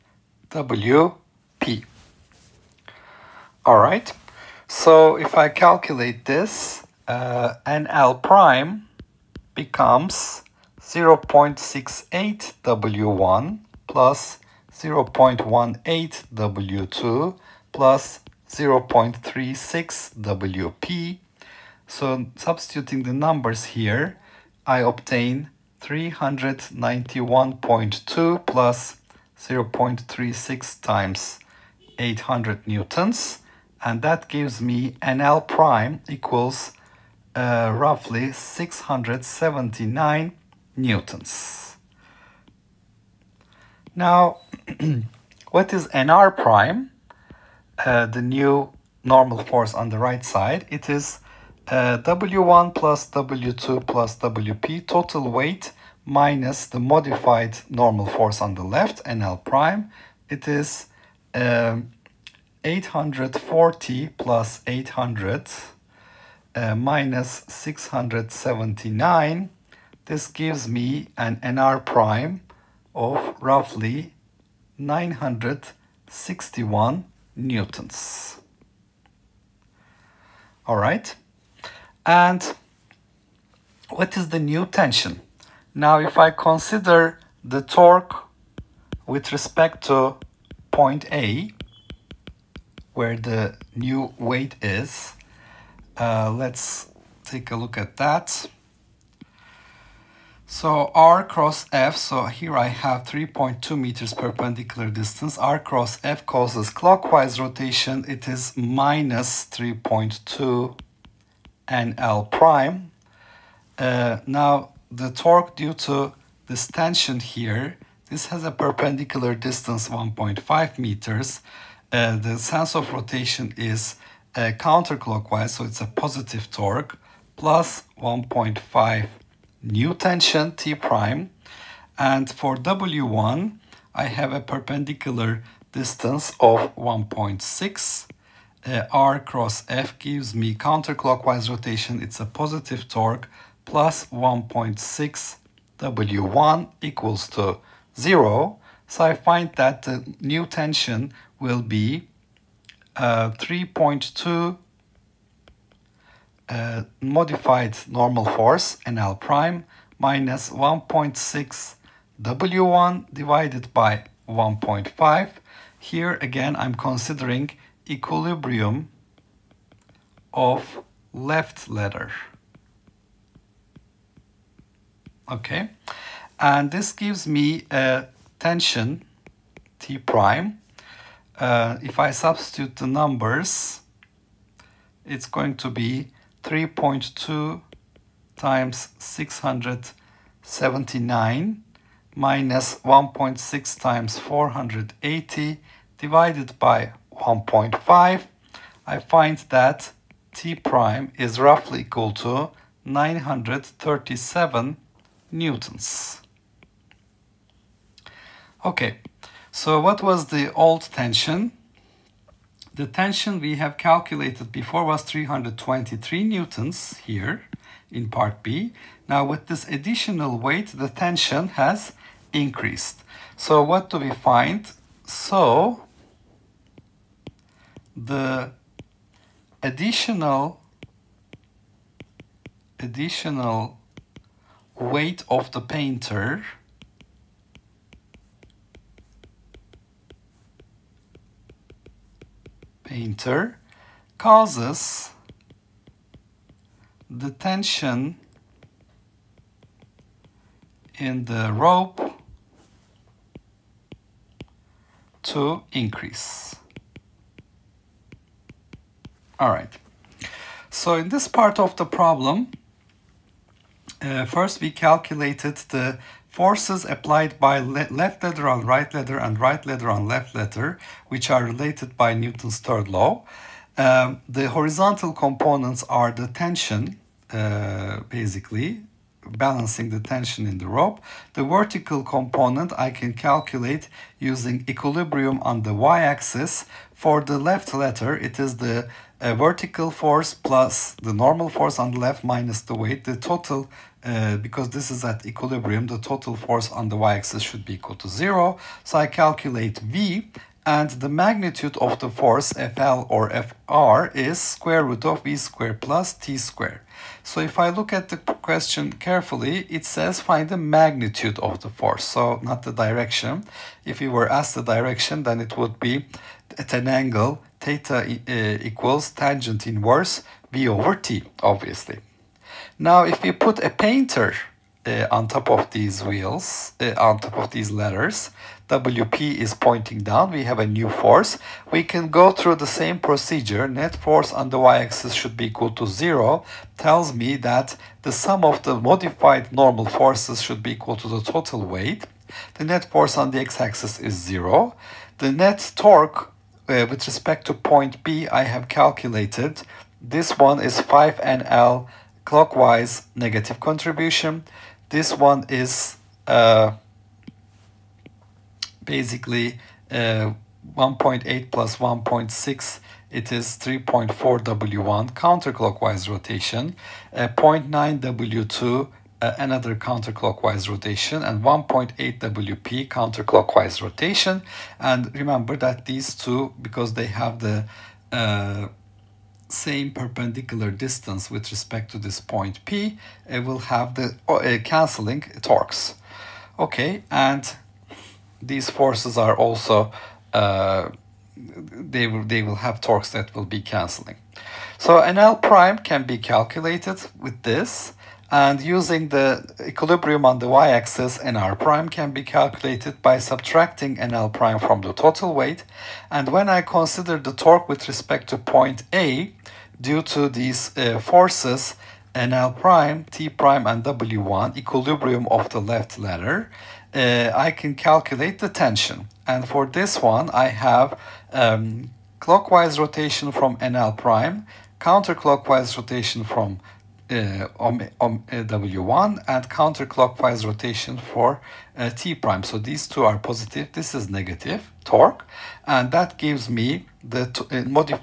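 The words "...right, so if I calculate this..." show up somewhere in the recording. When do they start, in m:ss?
0:03.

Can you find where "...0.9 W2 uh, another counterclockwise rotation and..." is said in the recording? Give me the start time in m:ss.
6:07.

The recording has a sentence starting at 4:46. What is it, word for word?
For the left letter, it is the uh, vertical force plus the normal force on the left minus the weight.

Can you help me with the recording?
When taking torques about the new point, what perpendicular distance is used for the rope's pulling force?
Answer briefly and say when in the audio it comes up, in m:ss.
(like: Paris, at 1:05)
1.5 meters, at 1:59.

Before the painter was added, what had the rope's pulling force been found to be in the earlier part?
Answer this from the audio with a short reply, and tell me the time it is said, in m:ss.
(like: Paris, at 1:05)
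323 newtons, at 3:35.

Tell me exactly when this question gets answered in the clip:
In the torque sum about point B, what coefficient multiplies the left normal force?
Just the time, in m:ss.
5:50.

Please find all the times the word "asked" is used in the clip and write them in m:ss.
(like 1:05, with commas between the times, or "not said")
5:14.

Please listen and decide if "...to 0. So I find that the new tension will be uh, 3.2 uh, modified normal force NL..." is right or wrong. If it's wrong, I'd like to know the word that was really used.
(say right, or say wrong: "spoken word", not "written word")
right.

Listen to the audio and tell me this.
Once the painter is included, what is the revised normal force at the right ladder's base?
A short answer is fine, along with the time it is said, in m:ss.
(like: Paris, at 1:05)
961 newtons, at 1:13.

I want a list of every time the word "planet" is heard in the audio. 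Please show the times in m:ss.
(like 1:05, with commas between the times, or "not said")
not said.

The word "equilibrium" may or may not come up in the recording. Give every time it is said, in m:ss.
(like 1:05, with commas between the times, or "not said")
2:47, 4:44, 4:55, 6:39, 6:54.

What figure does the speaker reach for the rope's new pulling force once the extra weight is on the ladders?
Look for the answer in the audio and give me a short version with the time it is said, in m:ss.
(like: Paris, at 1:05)
937 newtons, at 3:22.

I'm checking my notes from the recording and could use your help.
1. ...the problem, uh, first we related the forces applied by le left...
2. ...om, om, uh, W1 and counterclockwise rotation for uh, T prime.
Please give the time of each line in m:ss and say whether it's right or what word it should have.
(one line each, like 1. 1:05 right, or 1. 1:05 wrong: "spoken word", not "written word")
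1. 4:21 wrong: "calculated", not "related"
2. 7:07 right.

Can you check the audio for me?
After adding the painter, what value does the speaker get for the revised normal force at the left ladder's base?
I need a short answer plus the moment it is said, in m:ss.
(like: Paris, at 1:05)
679 newtons, at 0:37.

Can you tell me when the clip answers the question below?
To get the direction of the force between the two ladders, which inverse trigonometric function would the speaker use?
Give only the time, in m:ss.
5:19.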